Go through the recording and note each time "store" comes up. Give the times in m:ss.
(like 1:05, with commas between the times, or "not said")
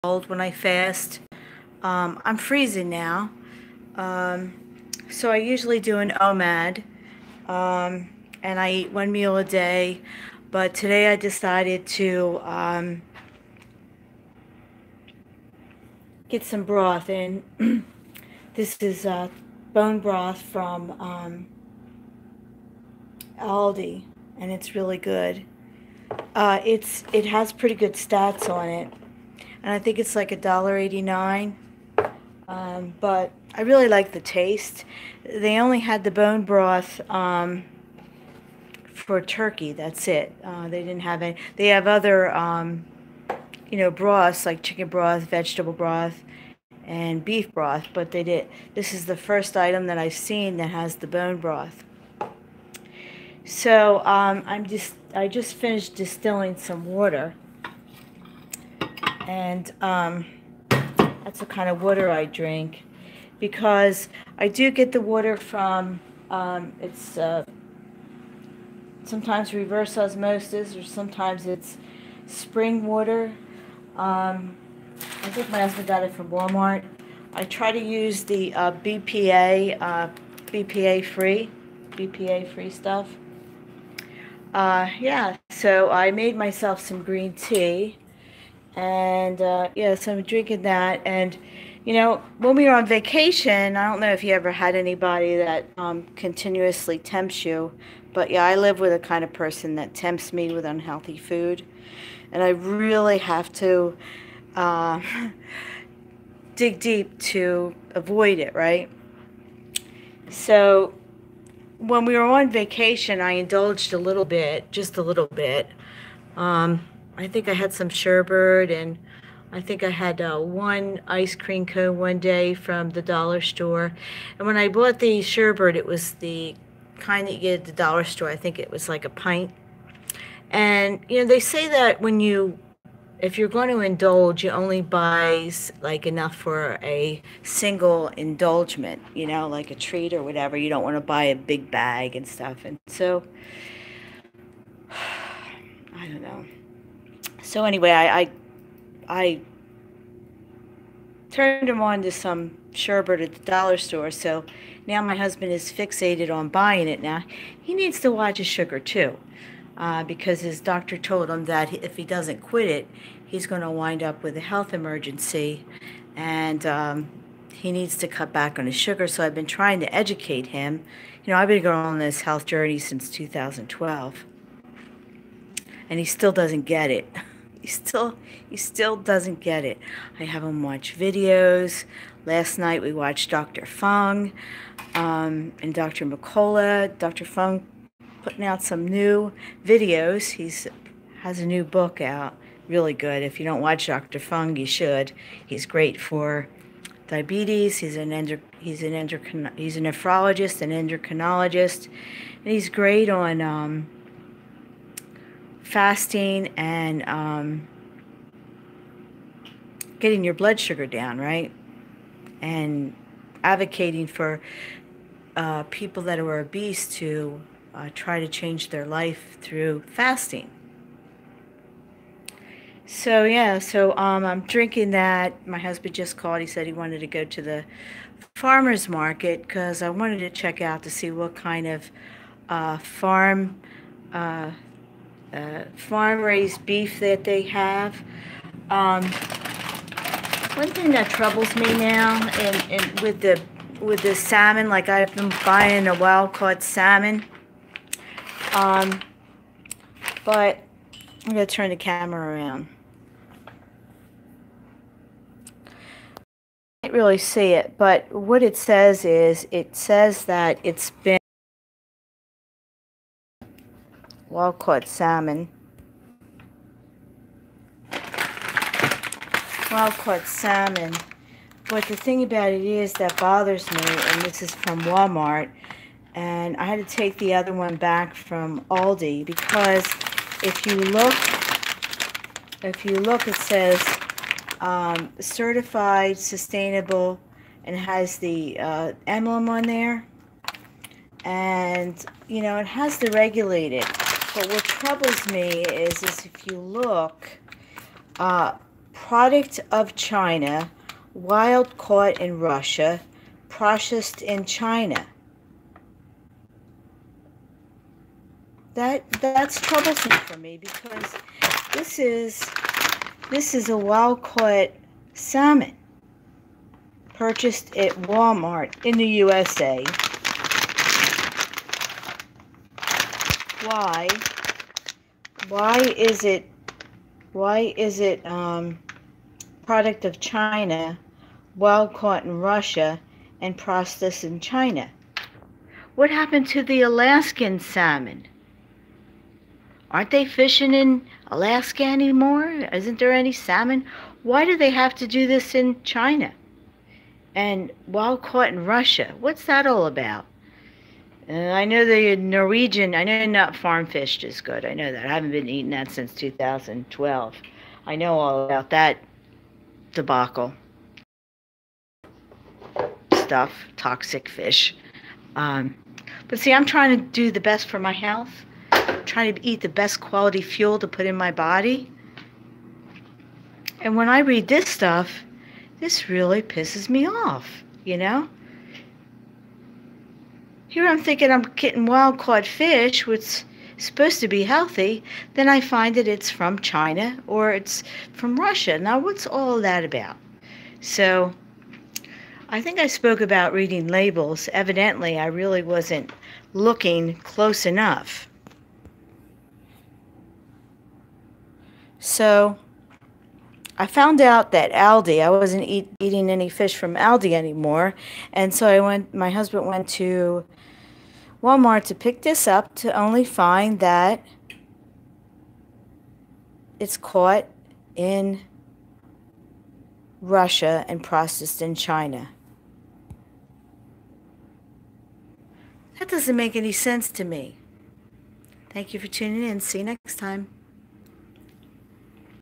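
2:03, 2:08, 2:33.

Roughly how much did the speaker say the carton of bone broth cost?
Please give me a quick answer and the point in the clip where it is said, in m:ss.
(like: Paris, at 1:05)
$1.89, at 0:30.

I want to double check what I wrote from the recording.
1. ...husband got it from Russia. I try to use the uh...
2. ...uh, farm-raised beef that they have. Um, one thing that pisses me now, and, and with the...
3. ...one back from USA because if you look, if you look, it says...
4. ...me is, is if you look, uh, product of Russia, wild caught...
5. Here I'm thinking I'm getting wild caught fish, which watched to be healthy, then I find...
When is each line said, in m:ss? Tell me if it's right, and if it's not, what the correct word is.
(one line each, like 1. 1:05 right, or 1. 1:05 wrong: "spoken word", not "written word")
1. 1:15 wrong: "Walmart", not "Russia"
2. 3:55 wrong: "troubles", not "pisses"
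3. 4:37 wrong: "Aldi", not "USA"
4. 4:55 wrong: "China", not "Russia"
5. 6:20 wrong: "supposed", not "watched".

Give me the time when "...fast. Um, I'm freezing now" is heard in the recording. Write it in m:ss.
0:00.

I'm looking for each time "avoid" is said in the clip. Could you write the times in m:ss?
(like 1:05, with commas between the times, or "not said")
1:47.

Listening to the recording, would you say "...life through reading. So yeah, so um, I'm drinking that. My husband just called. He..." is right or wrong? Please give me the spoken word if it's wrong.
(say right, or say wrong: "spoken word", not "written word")
wrong: "fasting", not "reading".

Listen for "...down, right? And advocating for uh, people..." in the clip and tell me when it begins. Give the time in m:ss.
3:30.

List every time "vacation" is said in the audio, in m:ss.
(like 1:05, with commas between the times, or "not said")
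1:32, 1:52.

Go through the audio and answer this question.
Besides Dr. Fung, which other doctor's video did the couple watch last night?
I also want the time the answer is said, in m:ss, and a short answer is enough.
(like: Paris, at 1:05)
Dr. McCullough, at 3:05.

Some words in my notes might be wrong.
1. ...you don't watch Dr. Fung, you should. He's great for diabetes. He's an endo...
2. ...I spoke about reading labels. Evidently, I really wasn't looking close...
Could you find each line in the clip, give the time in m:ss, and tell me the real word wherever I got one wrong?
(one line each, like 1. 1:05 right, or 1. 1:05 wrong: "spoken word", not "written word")
1. 3:13 right
2. 6:32 right.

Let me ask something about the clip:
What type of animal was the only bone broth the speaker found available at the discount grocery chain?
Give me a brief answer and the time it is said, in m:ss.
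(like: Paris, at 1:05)
Turkey, at 0:38.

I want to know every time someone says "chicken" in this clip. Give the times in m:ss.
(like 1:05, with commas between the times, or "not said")
0:44.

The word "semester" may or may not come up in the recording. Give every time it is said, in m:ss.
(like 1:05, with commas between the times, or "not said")
not said.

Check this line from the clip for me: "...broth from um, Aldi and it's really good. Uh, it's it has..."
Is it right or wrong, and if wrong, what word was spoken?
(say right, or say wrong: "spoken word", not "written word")
right.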